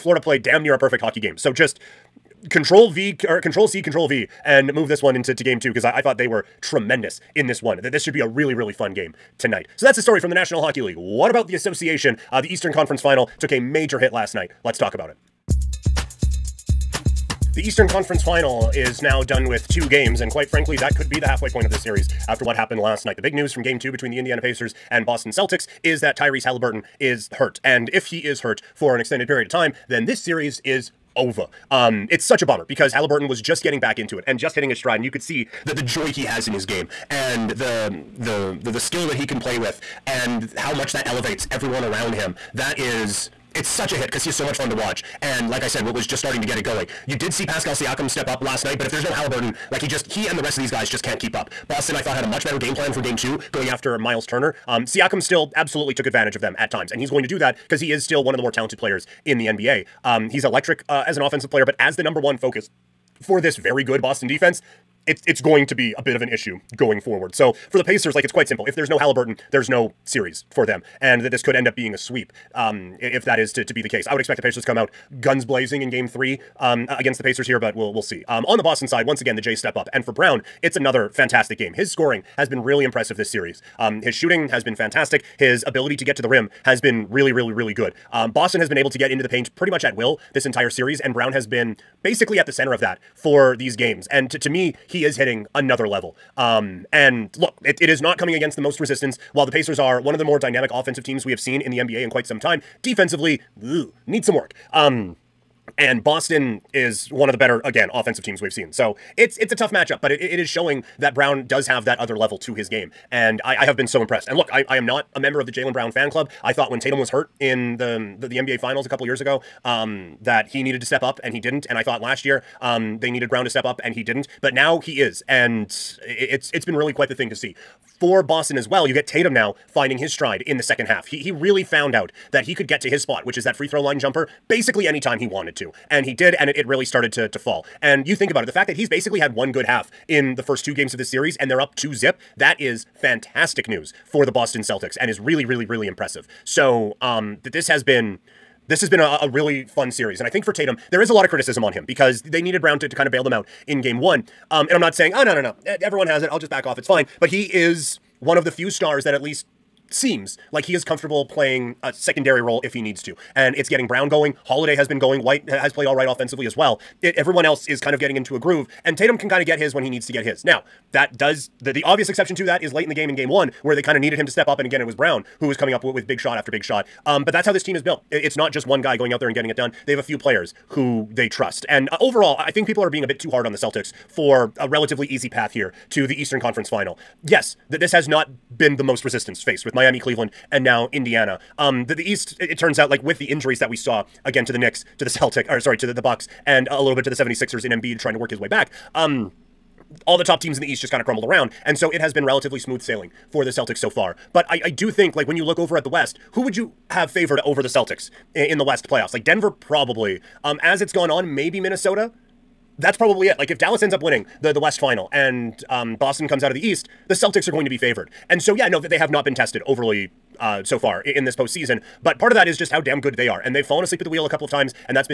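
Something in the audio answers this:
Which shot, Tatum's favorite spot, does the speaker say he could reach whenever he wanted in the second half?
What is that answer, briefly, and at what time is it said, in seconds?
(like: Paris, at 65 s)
free throw line jumper, at 133 s.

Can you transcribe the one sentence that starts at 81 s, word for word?
His scoring has been really impressive this series.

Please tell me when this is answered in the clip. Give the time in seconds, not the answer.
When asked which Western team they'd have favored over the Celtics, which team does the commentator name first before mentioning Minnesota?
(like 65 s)
209 s.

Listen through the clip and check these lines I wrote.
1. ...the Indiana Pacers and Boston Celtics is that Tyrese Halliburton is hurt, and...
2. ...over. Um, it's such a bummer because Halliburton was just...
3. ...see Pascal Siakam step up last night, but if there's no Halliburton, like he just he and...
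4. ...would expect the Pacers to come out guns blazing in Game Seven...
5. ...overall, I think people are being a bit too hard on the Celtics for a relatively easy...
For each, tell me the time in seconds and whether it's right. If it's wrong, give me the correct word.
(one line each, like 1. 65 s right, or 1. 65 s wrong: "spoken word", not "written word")
1. 24 s right
2. 31 s right
3. 47 s right
4. 74 s wrong: "Three", not "Seven"
5. 181 s right.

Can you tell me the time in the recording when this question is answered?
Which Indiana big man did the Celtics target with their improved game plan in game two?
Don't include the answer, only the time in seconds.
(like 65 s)
53 s.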